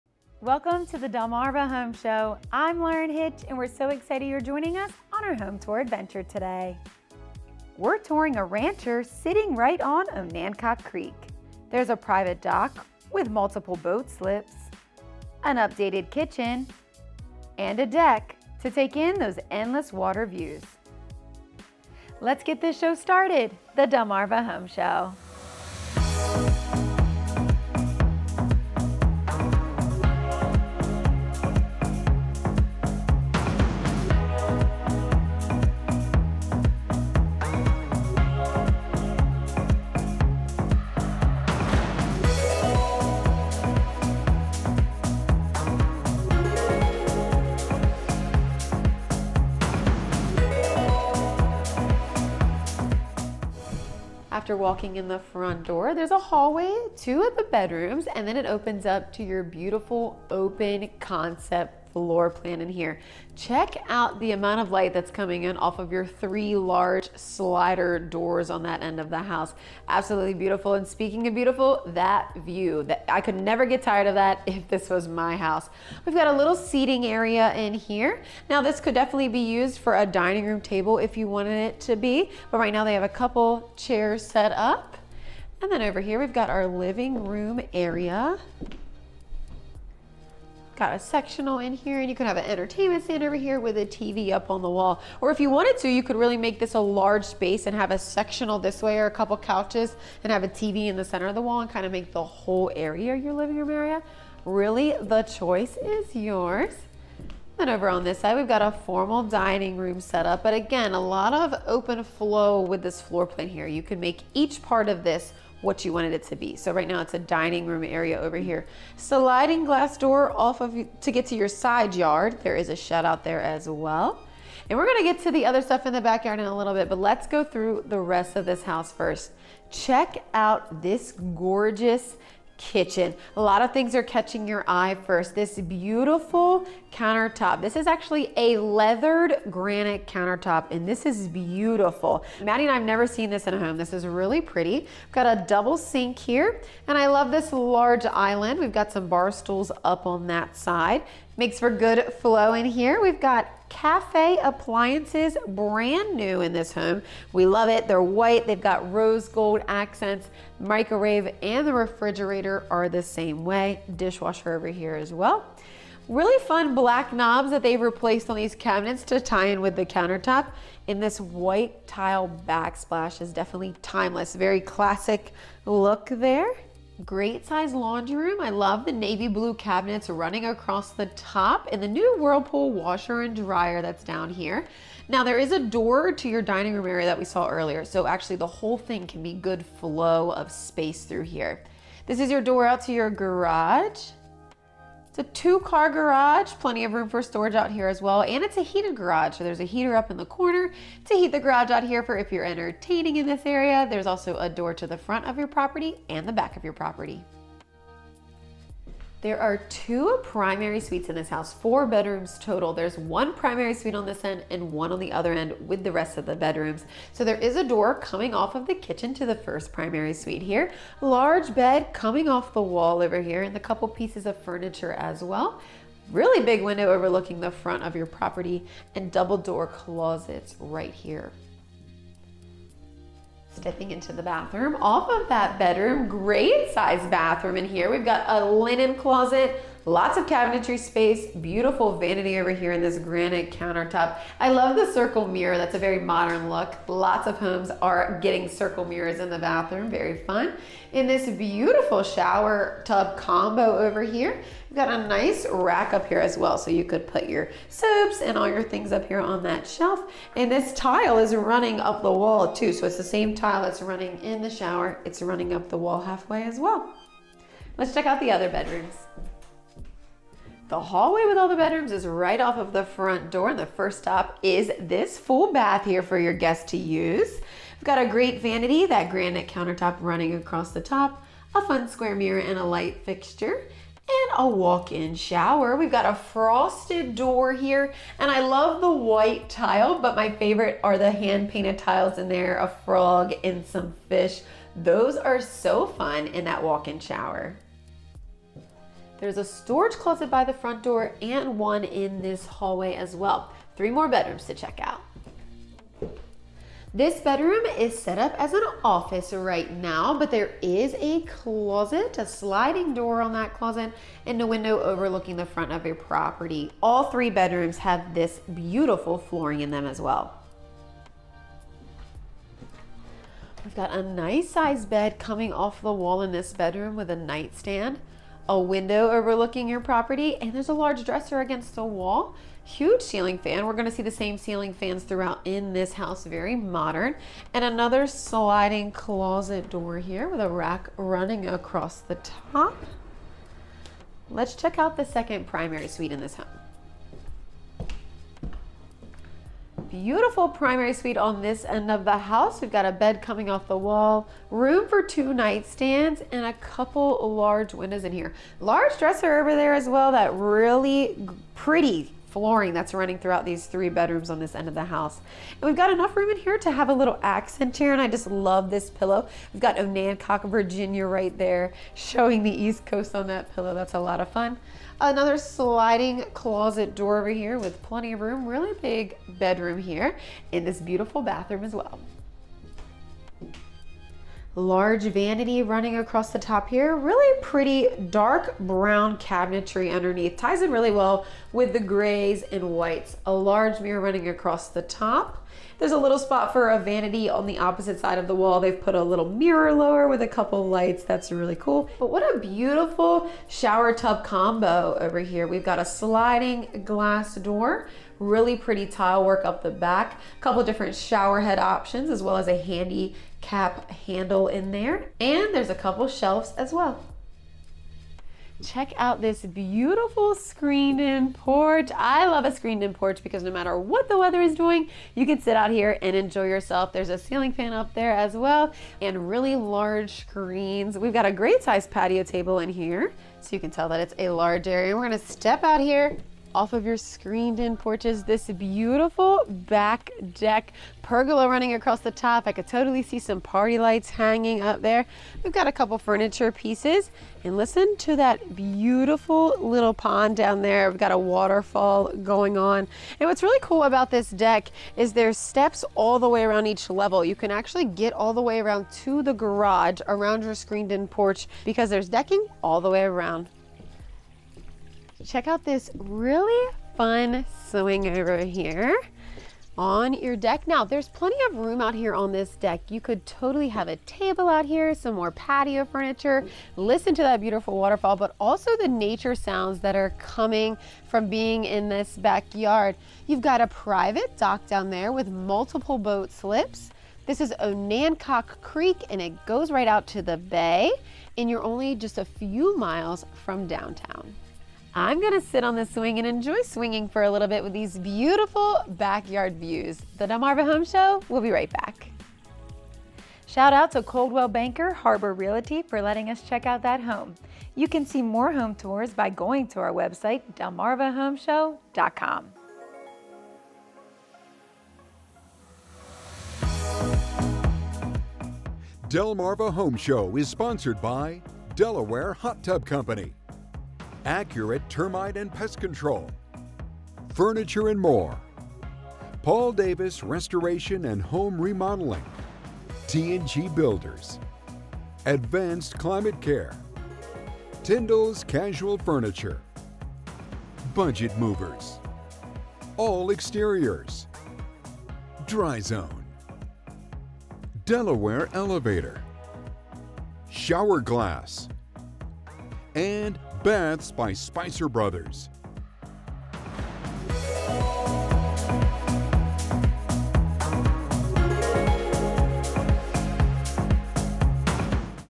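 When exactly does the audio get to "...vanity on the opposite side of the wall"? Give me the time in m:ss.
6:36.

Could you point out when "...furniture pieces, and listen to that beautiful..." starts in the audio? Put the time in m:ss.
7:25.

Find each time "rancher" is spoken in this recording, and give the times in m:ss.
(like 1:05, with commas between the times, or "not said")
0:08.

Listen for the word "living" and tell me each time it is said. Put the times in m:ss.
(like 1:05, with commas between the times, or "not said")
1:26, 1:43.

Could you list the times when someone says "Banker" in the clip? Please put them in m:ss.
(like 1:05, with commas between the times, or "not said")
8:24.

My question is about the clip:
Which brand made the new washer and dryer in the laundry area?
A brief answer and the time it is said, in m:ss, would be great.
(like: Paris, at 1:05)
Whirlpool, at 3:02.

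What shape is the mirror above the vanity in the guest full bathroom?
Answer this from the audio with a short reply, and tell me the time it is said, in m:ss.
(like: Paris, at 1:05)
Square, at 4:41.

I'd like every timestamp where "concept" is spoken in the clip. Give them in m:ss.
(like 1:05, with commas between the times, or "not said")
1:01.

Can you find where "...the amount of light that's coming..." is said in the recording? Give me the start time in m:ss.
1:04.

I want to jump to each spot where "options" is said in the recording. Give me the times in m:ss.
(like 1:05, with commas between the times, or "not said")
6:51.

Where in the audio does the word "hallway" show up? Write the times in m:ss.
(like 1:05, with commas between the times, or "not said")
0:56, 4:30, 5:02.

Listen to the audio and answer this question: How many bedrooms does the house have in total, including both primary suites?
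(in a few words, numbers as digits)
4.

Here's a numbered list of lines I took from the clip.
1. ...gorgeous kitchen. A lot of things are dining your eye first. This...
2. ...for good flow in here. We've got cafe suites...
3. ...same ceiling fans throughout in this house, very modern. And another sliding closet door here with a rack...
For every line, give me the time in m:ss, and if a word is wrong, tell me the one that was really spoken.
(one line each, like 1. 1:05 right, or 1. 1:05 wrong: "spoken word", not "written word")
1. 2:11 wrong: "catching", not "dining"
2. 2:31 wrong: "appliances", not "suites"
3. 5:34 right.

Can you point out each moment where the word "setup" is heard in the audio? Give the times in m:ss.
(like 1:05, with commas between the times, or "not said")
1:50.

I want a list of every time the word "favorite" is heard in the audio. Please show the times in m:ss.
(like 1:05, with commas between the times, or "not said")
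4:50.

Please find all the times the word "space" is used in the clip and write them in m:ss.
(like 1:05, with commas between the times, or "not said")
1:37, 3:10, 4:00.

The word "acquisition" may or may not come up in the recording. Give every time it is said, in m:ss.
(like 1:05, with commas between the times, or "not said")
not said.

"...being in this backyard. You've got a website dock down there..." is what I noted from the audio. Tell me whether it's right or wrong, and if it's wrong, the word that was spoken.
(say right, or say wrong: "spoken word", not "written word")
wrong: "private", not "website".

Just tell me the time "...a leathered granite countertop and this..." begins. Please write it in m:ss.
2:18.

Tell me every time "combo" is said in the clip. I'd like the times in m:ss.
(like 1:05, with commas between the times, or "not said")
4:13, 6:44.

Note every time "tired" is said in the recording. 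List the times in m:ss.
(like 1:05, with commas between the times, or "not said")
1:13.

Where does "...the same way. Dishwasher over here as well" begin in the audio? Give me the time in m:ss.
2:42.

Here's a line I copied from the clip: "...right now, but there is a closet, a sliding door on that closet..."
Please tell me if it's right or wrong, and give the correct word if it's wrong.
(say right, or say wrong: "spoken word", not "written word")
right.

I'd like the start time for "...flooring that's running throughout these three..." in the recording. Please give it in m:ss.
6:02.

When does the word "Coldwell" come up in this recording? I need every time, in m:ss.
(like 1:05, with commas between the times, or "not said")
8:24.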